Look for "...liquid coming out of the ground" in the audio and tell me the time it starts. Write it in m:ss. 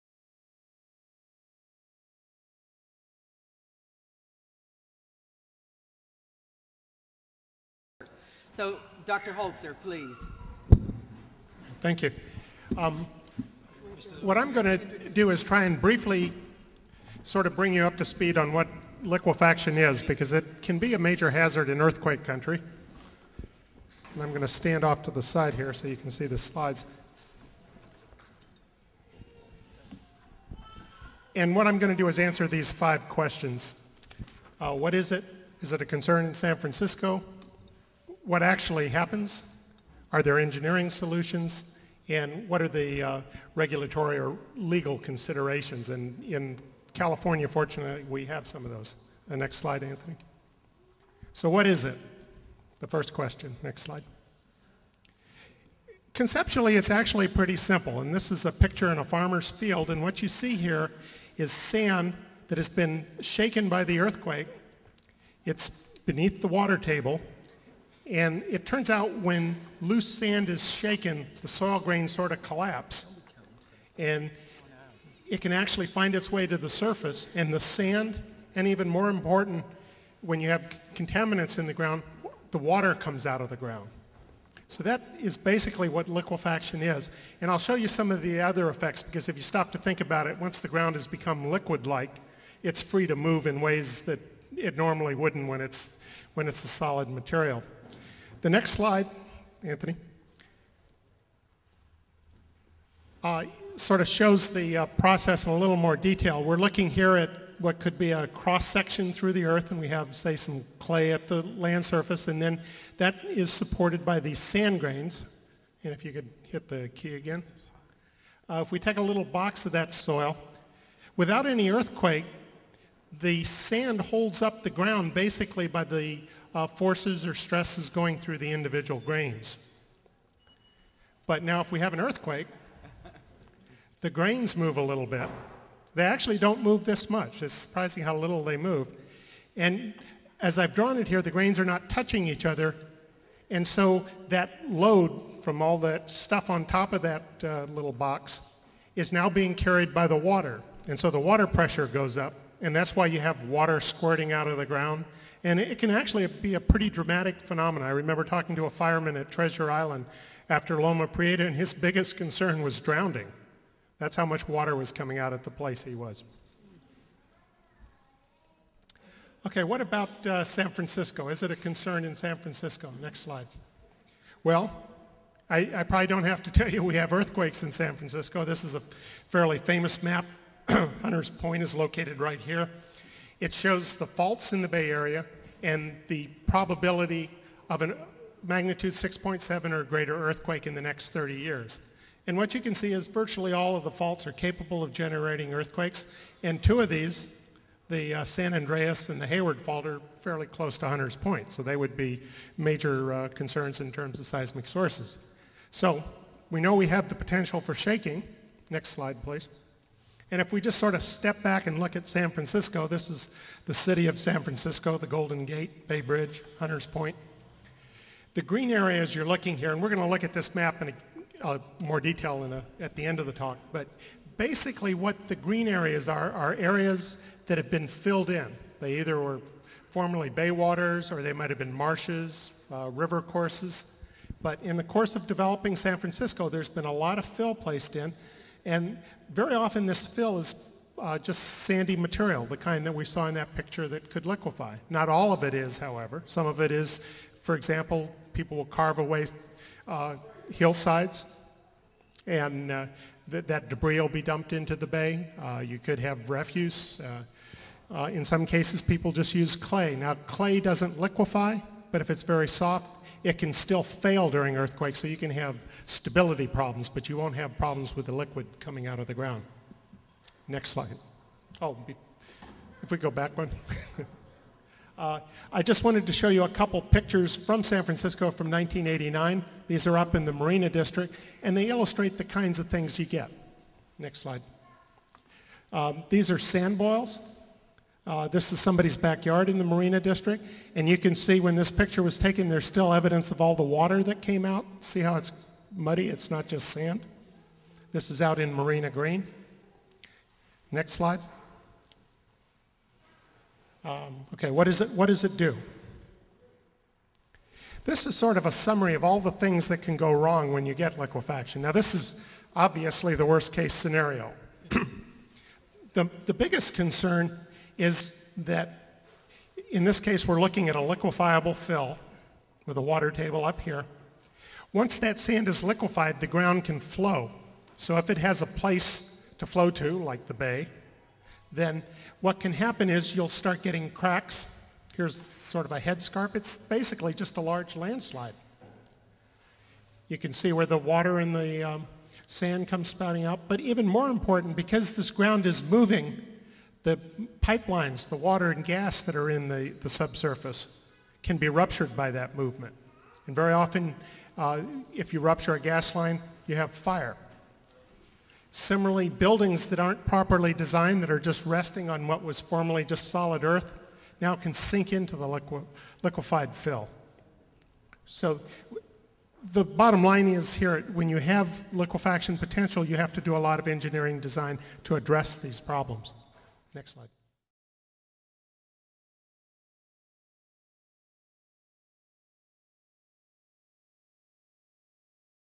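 4:28.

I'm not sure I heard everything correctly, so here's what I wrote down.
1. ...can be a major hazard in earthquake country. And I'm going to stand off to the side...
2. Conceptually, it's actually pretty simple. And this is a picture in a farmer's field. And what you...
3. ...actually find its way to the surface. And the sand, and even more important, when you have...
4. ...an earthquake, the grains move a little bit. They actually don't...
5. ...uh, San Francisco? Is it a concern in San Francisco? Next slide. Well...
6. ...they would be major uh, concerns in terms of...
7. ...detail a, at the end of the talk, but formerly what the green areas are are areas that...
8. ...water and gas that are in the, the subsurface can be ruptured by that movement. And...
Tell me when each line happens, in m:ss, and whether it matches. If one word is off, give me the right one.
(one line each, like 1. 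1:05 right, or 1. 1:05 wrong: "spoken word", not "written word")
1. 0:20 right
2. 0:56 right
3. 1:15 right
4. 2:11 right
5. 2:50 right
6. 3:21 right
7. 3:41 wrong: "basically", not "formerly"
8. 5:48 right.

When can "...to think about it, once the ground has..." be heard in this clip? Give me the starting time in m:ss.
1:29.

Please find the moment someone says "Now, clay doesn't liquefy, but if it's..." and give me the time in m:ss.
4:19.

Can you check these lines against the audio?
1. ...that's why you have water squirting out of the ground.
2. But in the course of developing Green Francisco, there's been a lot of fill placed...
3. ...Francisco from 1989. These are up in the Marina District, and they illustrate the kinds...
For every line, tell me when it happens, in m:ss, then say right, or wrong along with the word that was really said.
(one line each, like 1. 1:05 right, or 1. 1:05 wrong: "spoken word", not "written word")
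1. 2:32 right
2. 3:54 wrong: "San", not "Green"
3. 4:37 right.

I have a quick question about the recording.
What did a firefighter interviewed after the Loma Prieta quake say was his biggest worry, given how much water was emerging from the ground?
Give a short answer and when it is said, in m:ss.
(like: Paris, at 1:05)
Drowning, at 2:42.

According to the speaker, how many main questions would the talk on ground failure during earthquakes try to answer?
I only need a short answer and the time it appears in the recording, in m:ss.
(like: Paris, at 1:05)
5, at 0:32.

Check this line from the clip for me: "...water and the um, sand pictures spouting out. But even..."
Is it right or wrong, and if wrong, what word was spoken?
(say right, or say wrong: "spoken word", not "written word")
wrong: "comes", not "pictures".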